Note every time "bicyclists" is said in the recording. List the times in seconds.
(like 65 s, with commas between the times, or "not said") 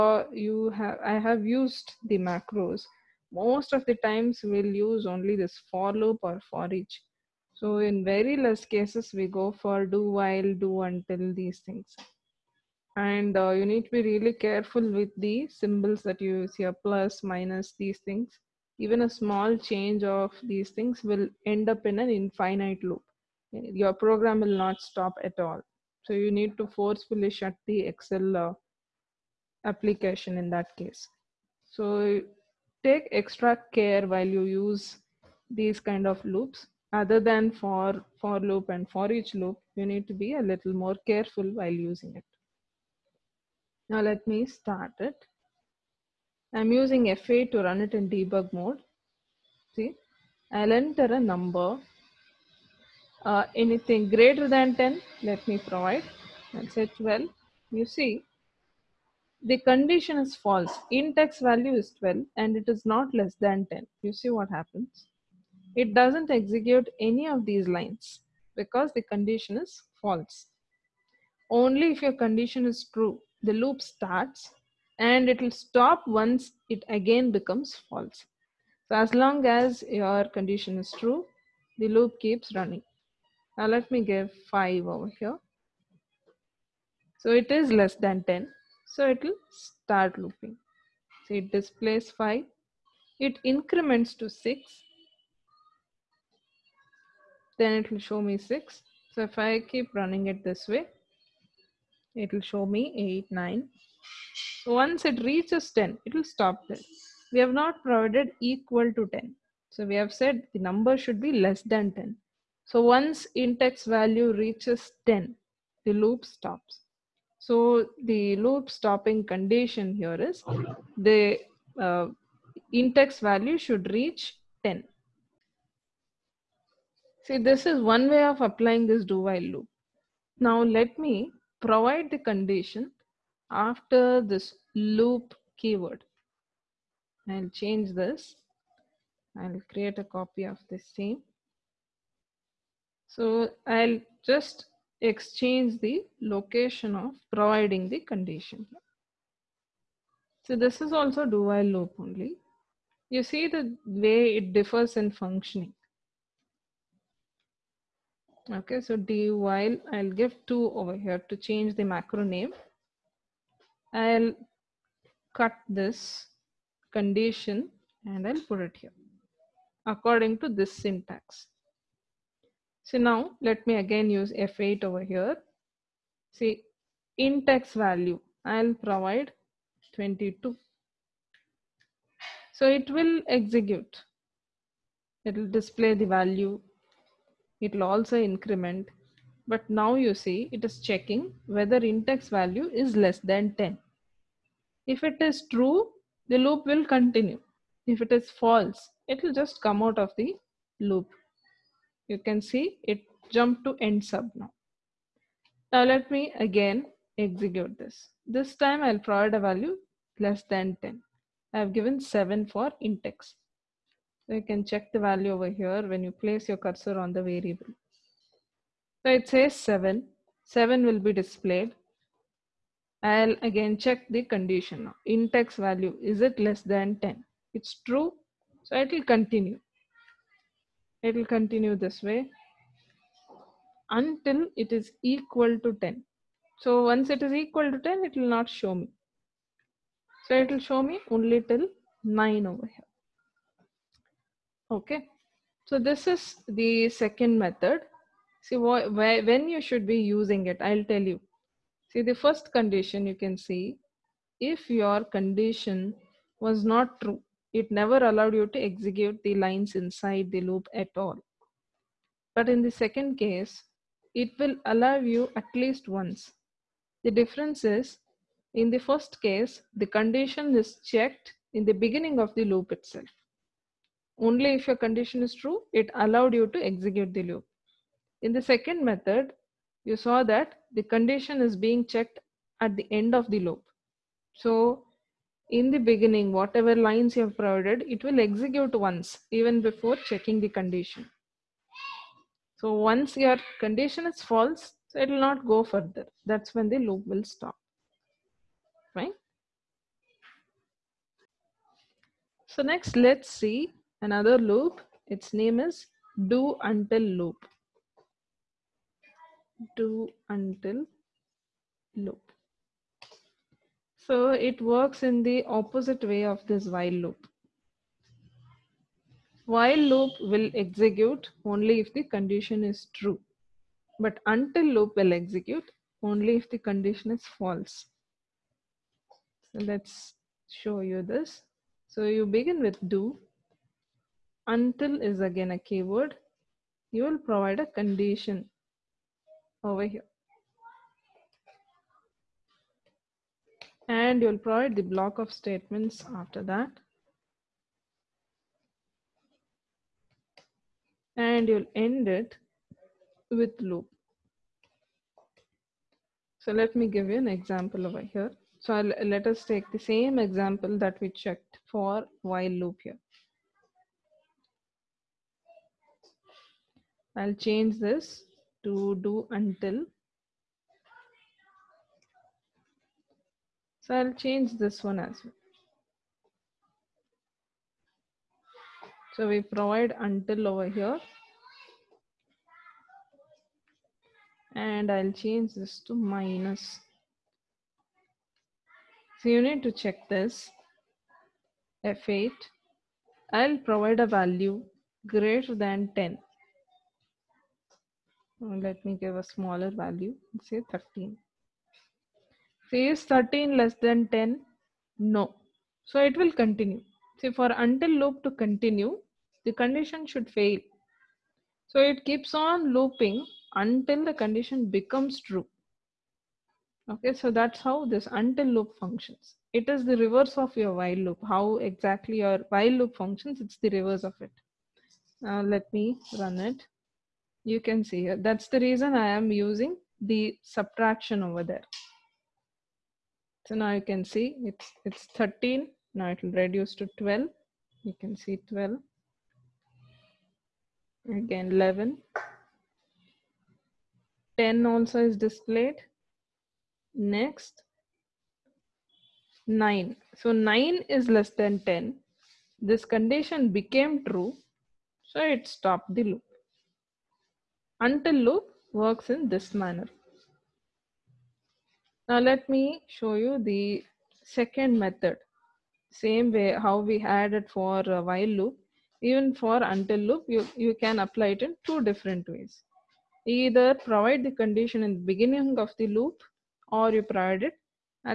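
not said.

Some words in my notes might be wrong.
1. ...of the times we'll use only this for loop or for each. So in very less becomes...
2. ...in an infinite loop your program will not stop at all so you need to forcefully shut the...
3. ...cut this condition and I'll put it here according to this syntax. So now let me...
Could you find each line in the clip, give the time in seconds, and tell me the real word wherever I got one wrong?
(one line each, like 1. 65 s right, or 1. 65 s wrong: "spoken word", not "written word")
1. 3 s wrong: "cases", not "becomes"
2. 21 s right
3. 165 s right.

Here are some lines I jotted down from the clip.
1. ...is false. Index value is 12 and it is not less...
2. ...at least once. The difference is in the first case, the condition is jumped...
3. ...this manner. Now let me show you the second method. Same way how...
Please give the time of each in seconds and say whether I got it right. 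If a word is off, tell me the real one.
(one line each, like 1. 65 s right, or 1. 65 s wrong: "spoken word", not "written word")
1. 60 s right
2. 265 s wrong: "checked", not "jumped"
3. 459 s right.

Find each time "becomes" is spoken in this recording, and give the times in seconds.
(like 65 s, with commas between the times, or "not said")
77 s, 414 s.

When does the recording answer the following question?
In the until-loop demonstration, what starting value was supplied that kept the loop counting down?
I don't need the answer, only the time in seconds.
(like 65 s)
400 s.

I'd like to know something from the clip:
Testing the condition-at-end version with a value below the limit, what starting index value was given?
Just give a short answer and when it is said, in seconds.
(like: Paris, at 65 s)
7, at 211 s.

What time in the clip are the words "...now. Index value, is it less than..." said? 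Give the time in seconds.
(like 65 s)
224 s.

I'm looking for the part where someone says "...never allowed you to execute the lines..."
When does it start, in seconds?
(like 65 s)
257 s.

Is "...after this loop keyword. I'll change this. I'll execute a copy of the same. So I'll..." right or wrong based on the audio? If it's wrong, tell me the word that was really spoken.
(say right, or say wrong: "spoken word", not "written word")
wrong: "create", not "execute".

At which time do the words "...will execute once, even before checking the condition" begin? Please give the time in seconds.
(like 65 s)
288 s.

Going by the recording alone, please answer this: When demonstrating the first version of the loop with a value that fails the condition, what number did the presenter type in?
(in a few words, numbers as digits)
12.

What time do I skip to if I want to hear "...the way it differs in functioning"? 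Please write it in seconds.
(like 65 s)
153 s.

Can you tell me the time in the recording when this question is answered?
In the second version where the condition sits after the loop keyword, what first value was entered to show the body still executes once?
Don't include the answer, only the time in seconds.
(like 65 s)
178 s.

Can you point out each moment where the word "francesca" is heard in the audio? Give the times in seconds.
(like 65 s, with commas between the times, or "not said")
not said.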